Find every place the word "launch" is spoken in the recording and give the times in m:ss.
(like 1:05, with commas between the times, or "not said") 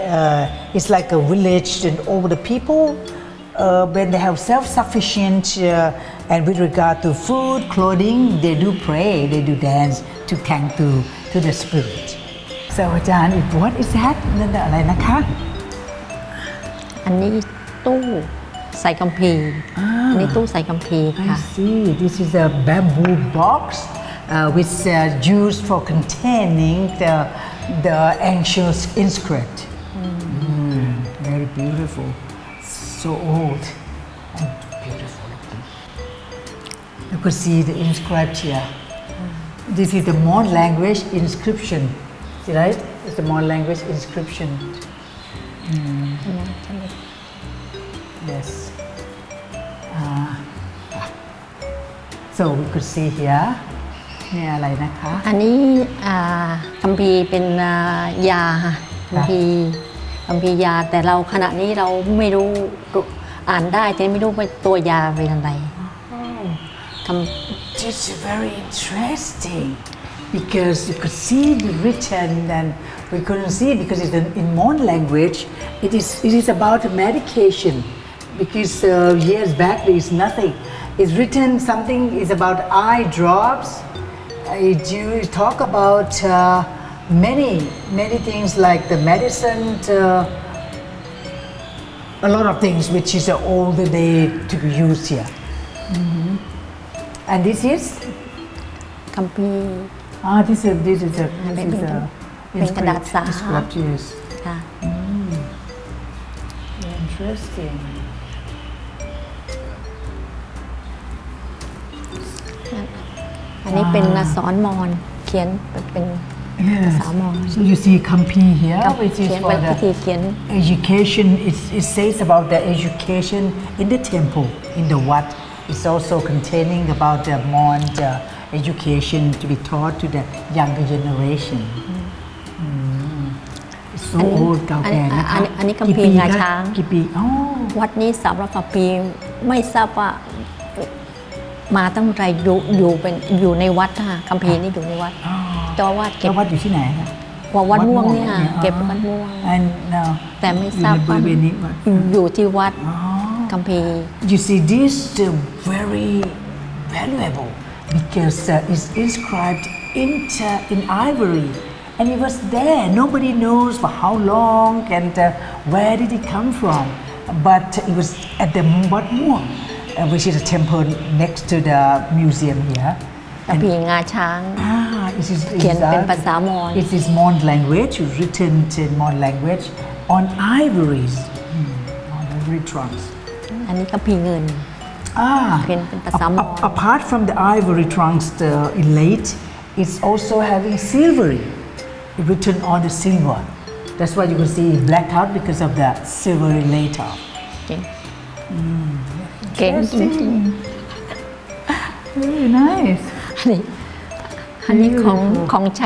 not said.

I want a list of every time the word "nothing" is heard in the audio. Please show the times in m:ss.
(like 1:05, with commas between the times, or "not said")
1:20.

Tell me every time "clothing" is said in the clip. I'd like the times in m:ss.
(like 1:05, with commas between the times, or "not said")
0:07.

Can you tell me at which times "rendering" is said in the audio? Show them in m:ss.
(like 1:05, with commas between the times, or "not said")
not said.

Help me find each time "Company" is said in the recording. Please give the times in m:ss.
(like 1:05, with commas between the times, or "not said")
1:39.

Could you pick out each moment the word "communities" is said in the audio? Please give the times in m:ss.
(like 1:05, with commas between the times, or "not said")
not said.